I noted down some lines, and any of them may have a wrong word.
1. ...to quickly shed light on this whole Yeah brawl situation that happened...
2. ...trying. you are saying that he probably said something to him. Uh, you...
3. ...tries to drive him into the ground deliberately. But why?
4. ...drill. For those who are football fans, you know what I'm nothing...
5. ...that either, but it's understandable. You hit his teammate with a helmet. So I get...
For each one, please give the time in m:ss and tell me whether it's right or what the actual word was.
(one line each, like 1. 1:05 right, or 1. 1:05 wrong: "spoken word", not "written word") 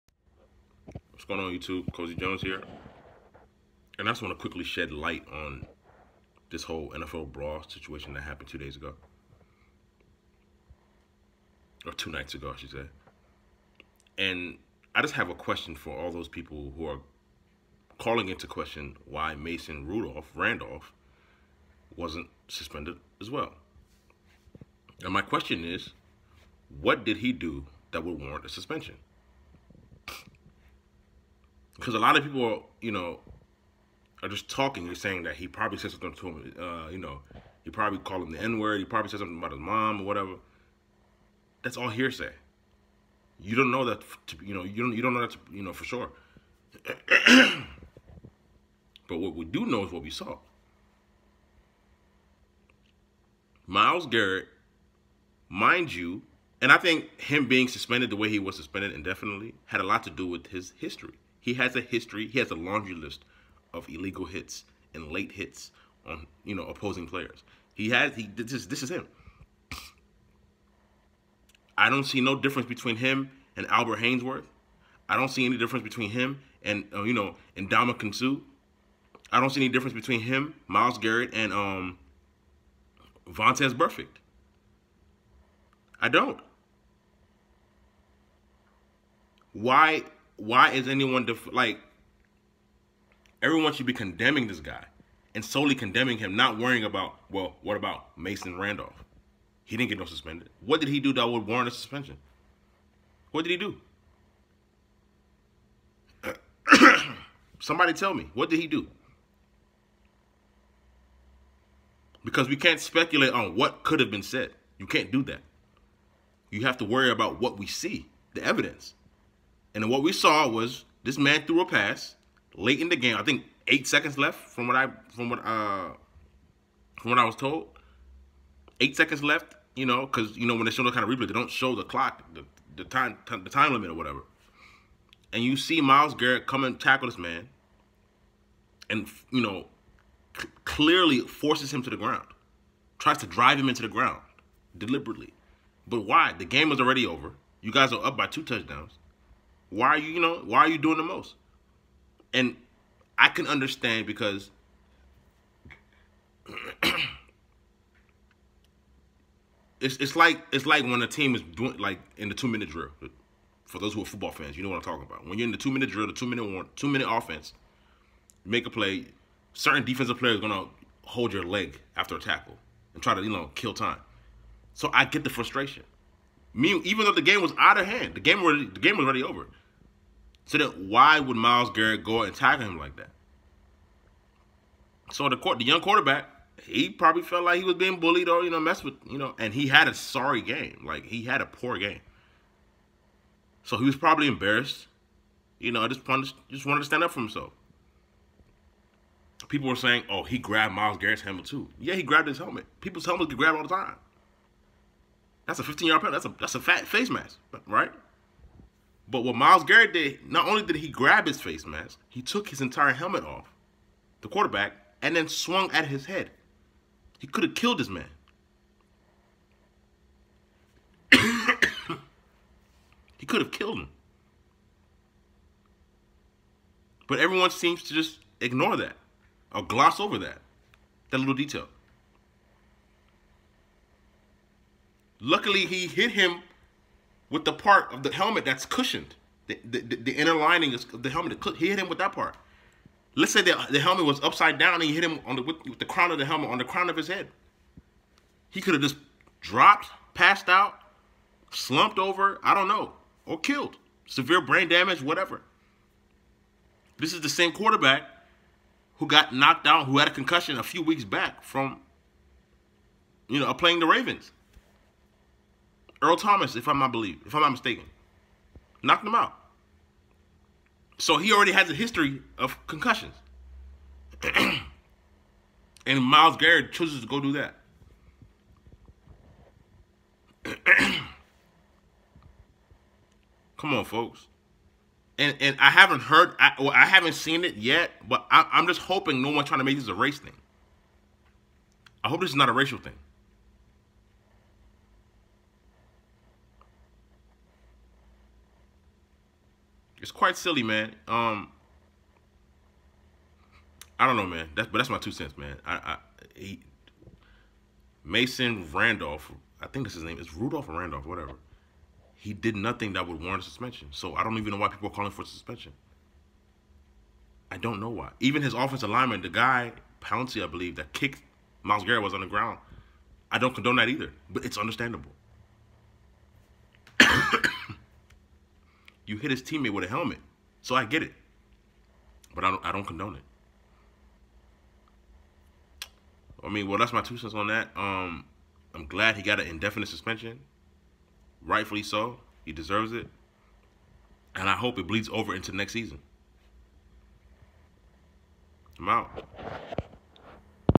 1. 0:04 wrong: "NFL", not "Yeah"
2. 0:34 wrong: "talking", not "trying"
3. 2:22 right
4. 2:42 wrong: "talking", not "nothing"
5. 5:23 right.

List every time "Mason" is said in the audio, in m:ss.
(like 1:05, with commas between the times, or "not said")
0:19, 1:38, 5:08.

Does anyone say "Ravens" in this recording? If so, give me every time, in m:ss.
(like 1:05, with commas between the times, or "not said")
4:23.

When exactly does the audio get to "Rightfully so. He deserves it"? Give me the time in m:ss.
5:41.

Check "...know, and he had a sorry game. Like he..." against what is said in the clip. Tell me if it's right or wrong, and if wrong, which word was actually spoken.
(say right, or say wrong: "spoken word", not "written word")
right.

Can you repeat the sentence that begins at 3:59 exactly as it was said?
The, the, the inner lining of the helmet.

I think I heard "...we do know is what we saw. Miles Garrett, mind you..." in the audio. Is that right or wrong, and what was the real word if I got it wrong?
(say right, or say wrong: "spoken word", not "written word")
right.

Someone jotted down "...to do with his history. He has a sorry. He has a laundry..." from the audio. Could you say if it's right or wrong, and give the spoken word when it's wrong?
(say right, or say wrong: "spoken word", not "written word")
wrong: "history", not "sorry".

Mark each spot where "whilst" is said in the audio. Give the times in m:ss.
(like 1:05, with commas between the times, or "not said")
not said.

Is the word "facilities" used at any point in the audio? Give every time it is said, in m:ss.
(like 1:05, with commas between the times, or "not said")
not said.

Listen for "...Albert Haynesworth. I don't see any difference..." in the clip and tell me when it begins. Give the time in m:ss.
1:13.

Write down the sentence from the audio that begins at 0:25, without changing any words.
And my question is, what did he do that would warrant a suspension?